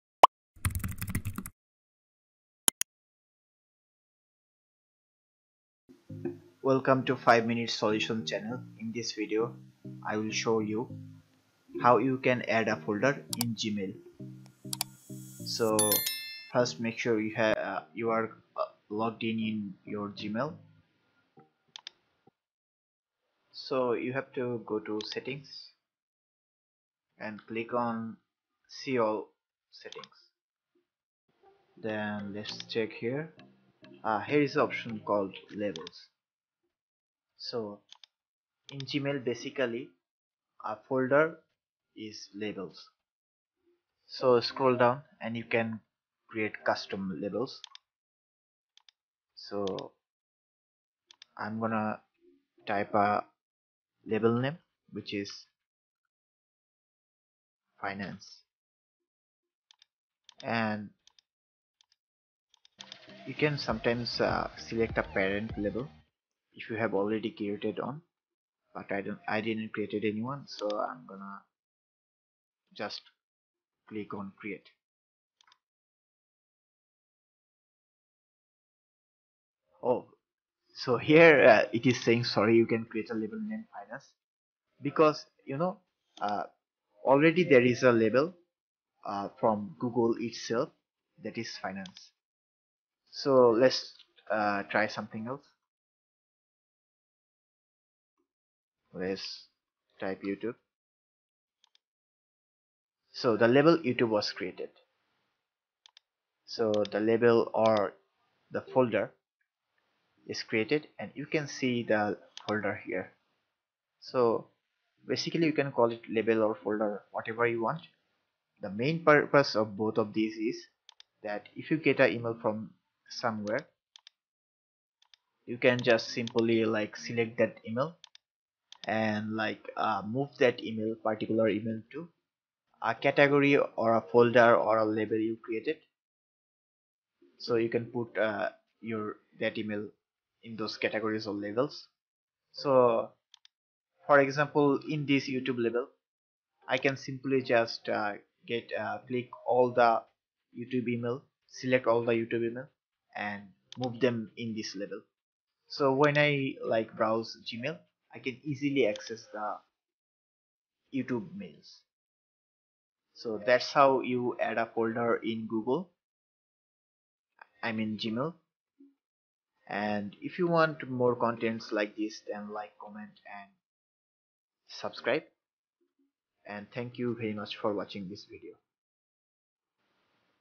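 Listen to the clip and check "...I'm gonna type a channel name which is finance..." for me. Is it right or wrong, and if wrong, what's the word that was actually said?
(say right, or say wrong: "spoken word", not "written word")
wrong: "label", not "channel".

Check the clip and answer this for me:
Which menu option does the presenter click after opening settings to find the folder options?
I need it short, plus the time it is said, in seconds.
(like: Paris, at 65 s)
see all settings, at 28 s.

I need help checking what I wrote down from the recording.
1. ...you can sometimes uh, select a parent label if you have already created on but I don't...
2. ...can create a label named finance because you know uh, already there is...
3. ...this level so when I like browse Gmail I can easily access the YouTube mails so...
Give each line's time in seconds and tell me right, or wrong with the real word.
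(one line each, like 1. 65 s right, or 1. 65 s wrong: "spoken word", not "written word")
1. 63 s right
2. 82 s right
3. 154 s right.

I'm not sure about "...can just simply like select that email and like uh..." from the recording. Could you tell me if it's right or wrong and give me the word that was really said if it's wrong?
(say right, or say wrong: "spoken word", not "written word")
right.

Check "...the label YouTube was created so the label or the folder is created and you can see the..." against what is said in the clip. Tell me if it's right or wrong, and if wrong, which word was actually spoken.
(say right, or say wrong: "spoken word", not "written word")
right.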